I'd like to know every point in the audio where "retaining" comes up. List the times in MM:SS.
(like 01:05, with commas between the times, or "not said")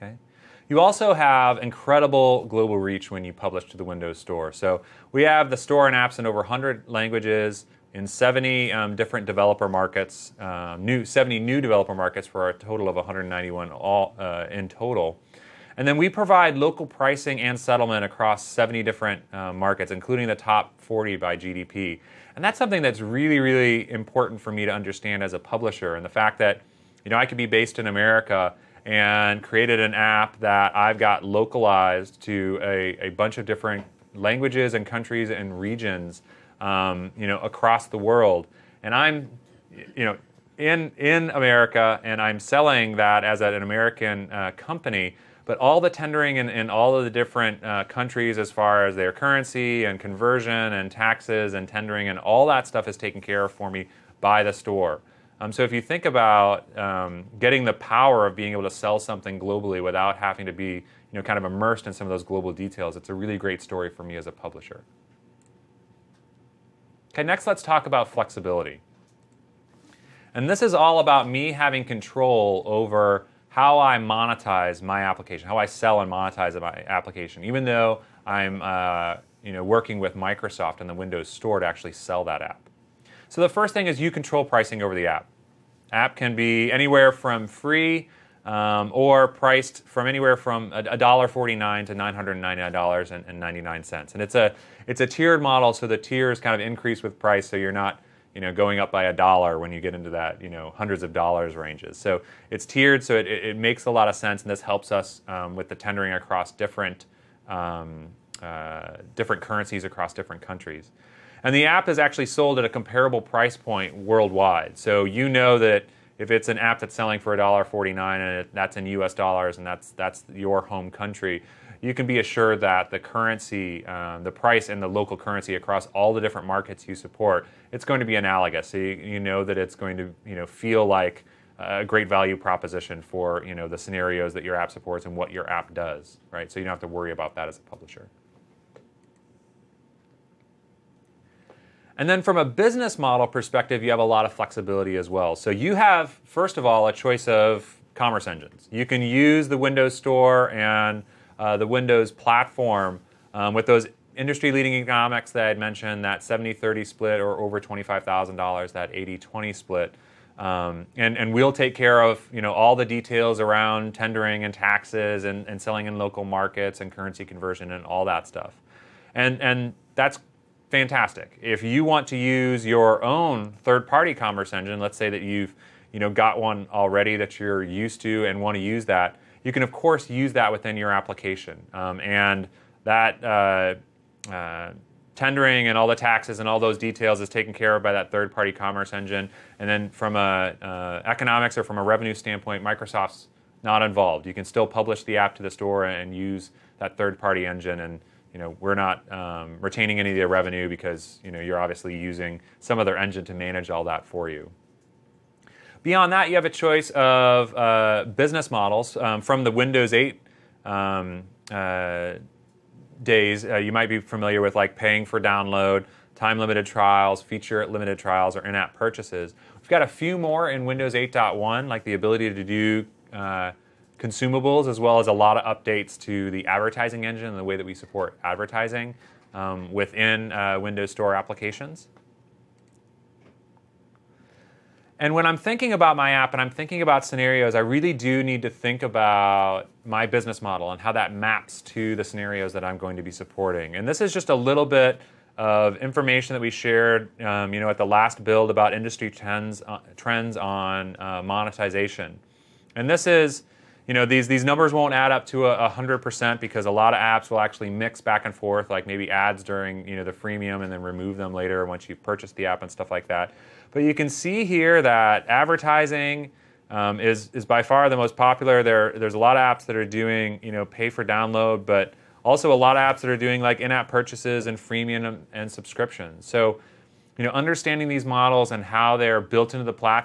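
03:19.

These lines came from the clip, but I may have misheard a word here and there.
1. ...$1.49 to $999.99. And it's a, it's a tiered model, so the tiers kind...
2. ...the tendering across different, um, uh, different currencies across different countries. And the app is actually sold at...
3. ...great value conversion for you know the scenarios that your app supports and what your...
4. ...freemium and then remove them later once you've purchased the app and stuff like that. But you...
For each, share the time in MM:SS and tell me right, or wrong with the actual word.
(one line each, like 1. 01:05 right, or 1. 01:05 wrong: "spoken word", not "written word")
1. 01:30 right
2. 01:45 right
3. 02:11 wrong: "proposition", not "conversion"
4. 04:20 right.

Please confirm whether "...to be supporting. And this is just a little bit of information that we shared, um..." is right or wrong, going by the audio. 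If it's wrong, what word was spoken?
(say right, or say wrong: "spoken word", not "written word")
right.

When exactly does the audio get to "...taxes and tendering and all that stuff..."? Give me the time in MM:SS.
00:50.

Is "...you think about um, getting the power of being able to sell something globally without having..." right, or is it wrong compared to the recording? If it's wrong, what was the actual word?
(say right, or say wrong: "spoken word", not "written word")
right.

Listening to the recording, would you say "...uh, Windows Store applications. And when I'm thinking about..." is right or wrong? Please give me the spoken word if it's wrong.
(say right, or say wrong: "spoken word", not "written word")
right.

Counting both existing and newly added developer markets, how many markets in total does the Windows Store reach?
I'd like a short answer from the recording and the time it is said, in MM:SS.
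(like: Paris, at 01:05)
191, at 00:12.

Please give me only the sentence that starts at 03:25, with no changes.
Beyond that, you have a choice of uh, business models um, from the Windows 8 um, uh, days.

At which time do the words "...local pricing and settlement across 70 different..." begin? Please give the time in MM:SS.
00:16.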